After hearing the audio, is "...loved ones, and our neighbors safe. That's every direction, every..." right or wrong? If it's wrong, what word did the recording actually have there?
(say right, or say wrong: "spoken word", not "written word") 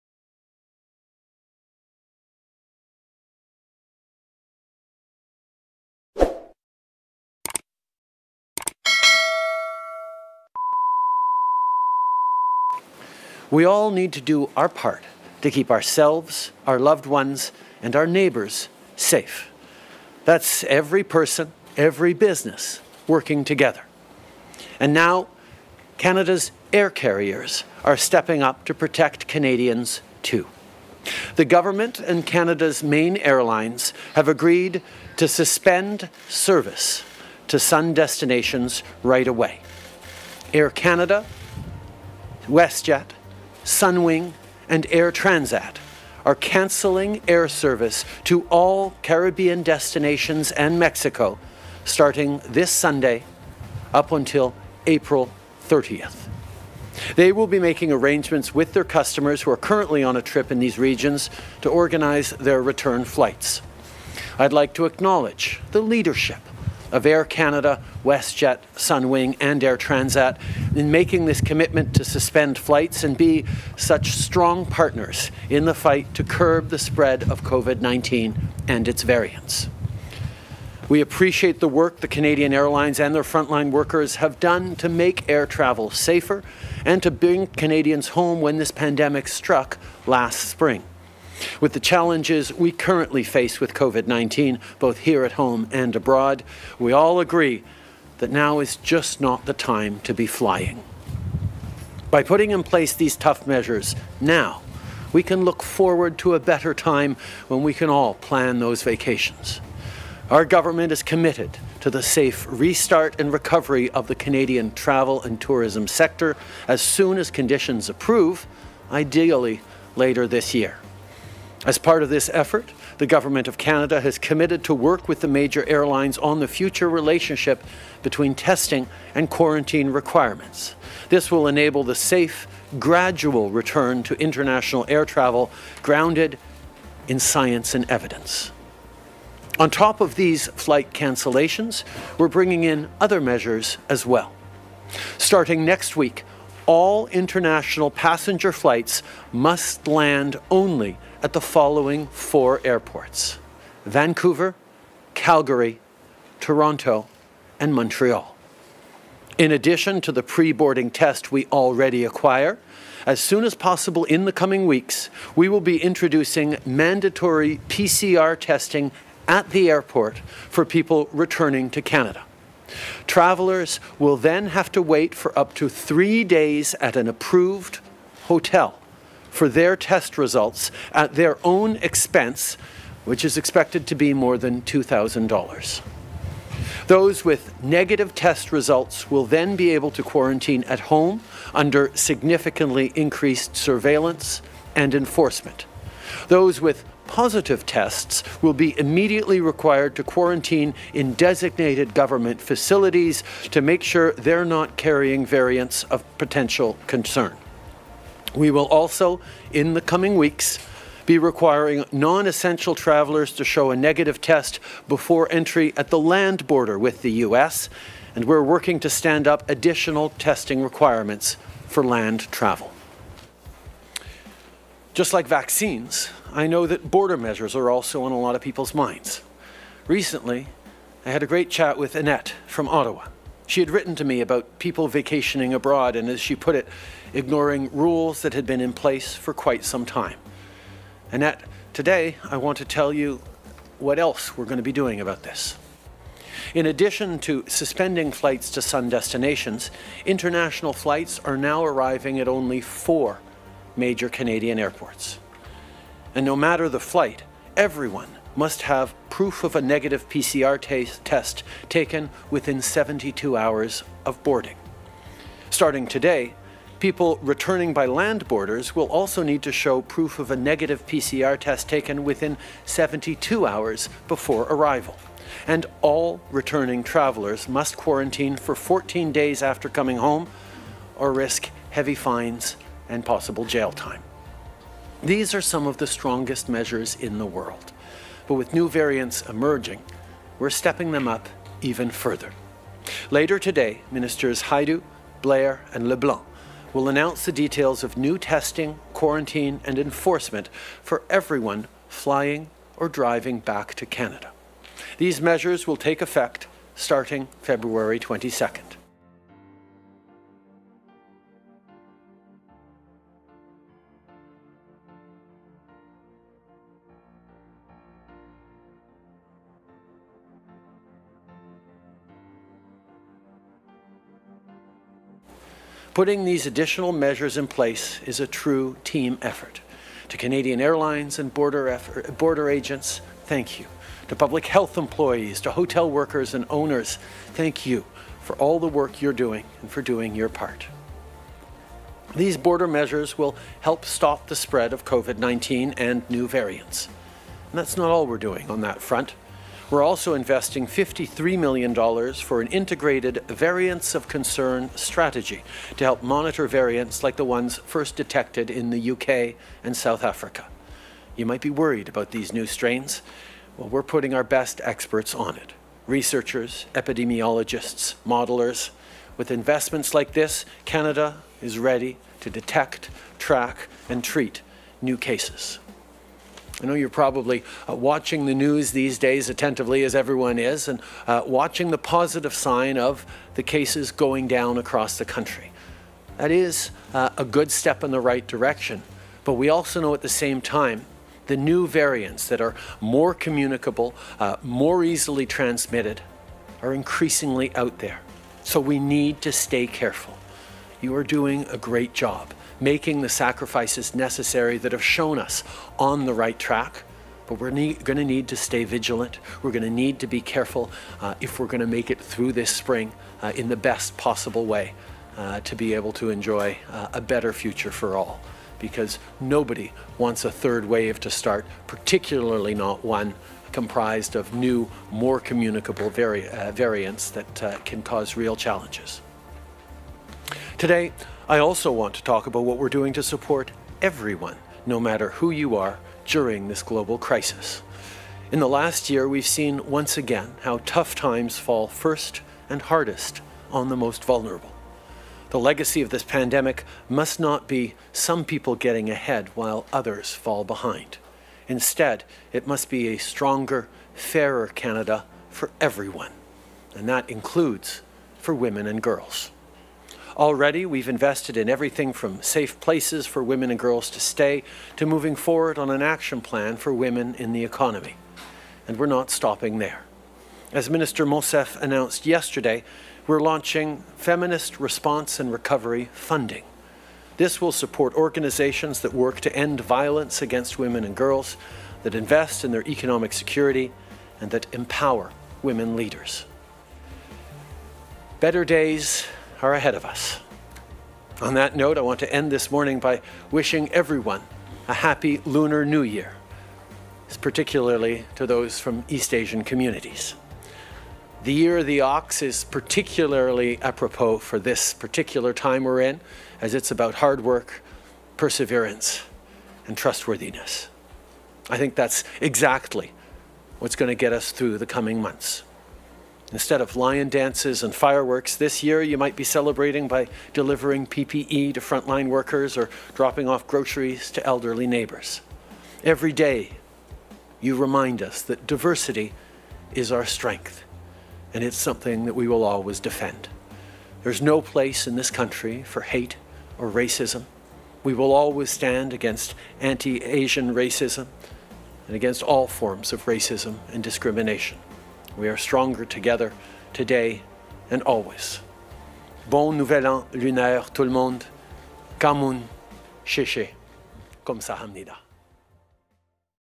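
wrong: "person", not "direction".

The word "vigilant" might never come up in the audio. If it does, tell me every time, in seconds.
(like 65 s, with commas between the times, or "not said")
408 s.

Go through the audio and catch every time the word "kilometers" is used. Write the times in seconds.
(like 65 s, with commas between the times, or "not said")
not said.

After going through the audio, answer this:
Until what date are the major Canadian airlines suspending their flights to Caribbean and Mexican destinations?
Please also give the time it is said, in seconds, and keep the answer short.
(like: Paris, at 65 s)
April 30th, at 54 s.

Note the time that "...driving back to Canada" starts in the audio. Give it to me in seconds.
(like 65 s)
302 s.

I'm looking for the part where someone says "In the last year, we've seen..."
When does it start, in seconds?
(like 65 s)
438 s.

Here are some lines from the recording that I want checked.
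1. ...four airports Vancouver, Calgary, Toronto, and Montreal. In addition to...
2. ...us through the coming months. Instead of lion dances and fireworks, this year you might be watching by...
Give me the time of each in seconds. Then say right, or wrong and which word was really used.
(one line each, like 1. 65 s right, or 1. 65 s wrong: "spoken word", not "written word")
1. 152 s right
2. 514 s wrong: "celebrating", not "watching".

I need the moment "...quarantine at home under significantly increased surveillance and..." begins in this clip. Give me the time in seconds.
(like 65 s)
190 s.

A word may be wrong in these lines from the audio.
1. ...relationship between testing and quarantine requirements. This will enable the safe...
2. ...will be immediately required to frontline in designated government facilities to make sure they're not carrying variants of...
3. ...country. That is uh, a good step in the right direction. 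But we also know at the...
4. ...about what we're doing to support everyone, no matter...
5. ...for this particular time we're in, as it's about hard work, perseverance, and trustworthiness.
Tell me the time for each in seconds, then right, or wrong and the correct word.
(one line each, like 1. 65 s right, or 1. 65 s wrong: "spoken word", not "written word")
1. 126 s right
2. 198 s wrong: "quarantine", not "frontline"
3. 385 s right
4. 432 s right
5. 504 s right.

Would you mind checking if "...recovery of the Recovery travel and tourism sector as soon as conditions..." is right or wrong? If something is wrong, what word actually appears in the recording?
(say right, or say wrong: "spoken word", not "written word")
wrong: "Canadian", not "Recovery".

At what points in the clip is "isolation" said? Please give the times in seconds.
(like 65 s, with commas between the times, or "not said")
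not said.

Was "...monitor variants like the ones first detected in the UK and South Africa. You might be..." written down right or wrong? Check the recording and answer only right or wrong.
right.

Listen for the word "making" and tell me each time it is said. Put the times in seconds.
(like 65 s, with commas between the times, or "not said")
57 s, 70 s, 402 s.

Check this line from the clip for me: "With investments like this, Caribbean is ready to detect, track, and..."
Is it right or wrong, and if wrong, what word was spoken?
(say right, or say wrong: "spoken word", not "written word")
wrong: "Canada", not "Caribbean".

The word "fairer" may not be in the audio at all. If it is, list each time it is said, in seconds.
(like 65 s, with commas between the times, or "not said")
453 s.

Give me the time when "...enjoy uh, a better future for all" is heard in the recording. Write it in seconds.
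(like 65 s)
416 s.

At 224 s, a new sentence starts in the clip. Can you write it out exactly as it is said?
Just like vaccines, I know that border measures are also on a lot of people's minds.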